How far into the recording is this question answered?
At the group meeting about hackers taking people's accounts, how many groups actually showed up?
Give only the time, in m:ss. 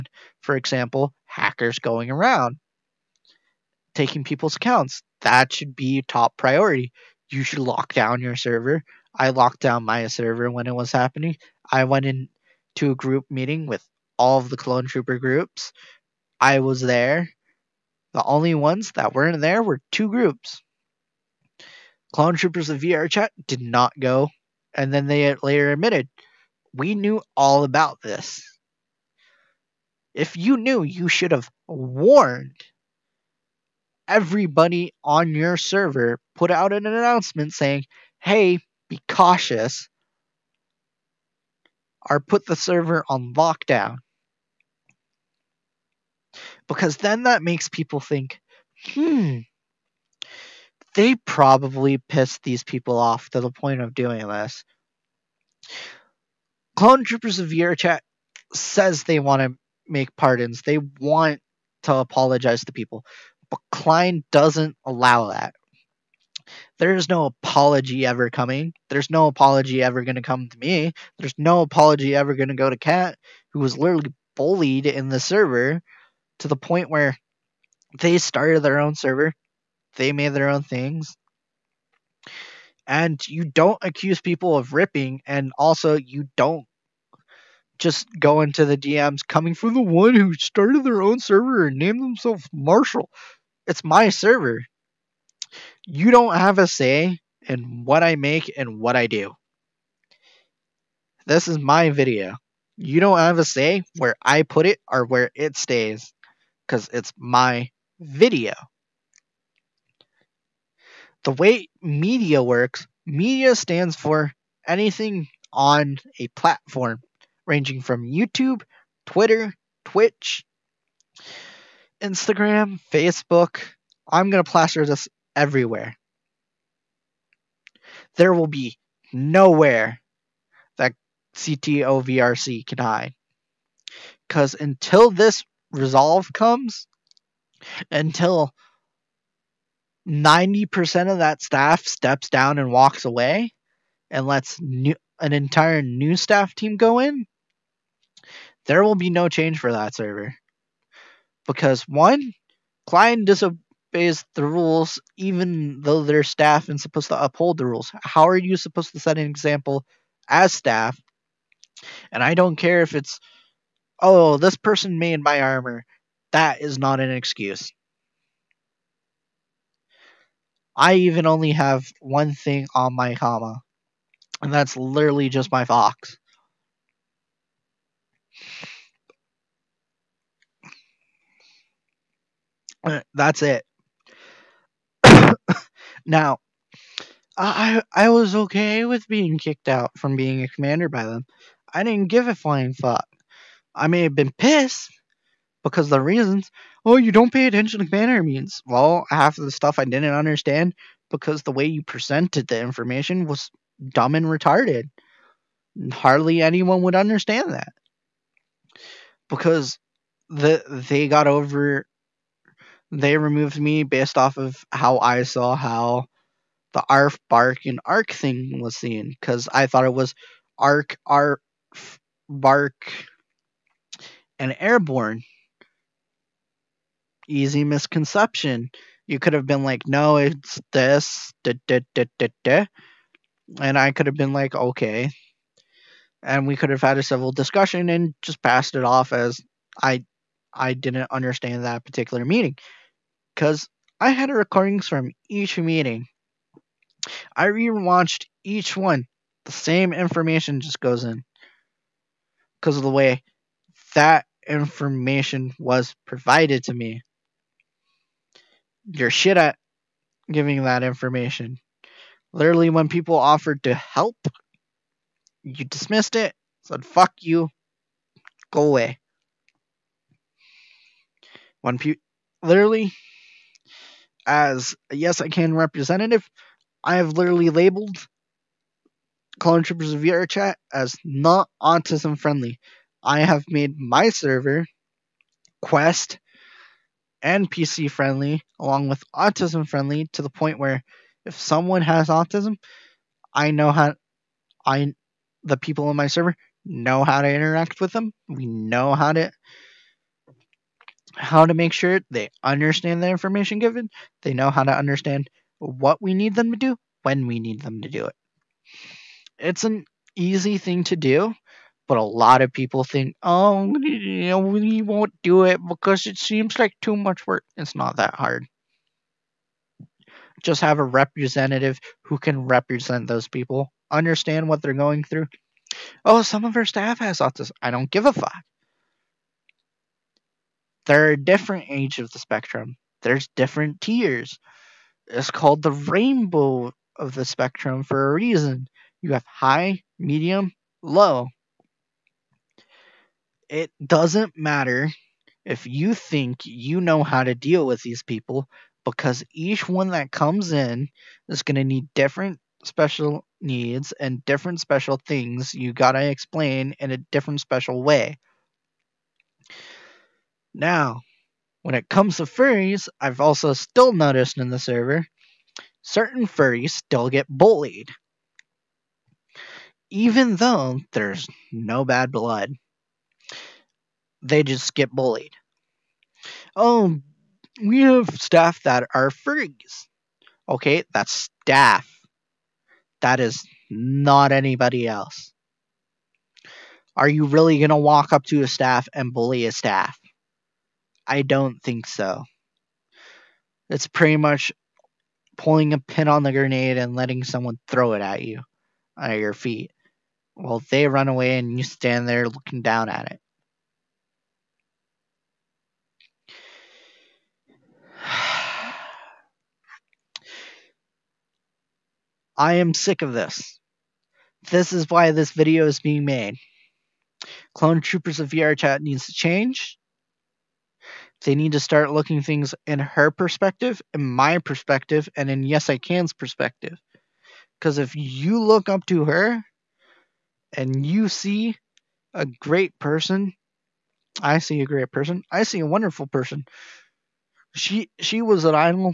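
0:19.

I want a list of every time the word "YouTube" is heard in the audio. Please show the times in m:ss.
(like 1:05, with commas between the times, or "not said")
1:58.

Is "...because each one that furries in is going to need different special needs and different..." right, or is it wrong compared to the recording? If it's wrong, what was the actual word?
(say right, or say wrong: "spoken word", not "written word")
wrong: "comes", not "furries".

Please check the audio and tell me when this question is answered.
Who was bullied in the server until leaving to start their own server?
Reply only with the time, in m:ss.
1:12.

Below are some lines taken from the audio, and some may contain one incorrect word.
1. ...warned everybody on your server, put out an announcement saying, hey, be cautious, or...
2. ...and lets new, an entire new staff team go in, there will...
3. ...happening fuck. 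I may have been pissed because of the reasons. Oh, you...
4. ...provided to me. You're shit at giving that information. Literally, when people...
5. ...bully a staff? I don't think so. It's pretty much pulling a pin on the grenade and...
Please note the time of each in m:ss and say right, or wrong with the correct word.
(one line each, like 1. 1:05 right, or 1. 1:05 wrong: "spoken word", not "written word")
1. 0:31 right
2. 2:24 right
3. 3:12 wrong: "flying", not "happening"
4. 4:16 right
5. 6:29 right.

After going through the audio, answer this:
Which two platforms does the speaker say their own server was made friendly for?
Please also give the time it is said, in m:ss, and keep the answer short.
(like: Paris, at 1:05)
Quest and PC, at 4:45.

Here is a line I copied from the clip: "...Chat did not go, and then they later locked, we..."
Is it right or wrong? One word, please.
wrong.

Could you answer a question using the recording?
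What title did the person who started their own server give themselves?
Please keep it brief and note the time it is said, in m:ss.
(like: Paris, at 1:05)
Marshall, at 1:32.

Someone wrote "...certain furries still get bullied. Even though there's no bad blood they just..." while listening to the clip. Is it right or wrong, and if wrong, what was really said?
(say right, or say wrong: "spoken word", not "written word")
right.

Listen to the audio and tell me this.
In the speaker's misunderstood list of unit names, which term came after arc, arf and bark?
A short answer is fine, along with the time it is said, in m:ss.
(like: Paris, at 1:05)
airborne, at 3:44.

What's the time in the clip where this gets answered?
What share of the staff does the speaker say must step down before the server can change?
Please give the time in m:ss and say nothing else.
2:20.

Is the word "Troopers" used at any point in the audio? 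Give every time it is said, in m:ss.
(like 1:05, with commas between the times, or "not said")
0:14, 0:22, 0:57, 4:39, 6:57.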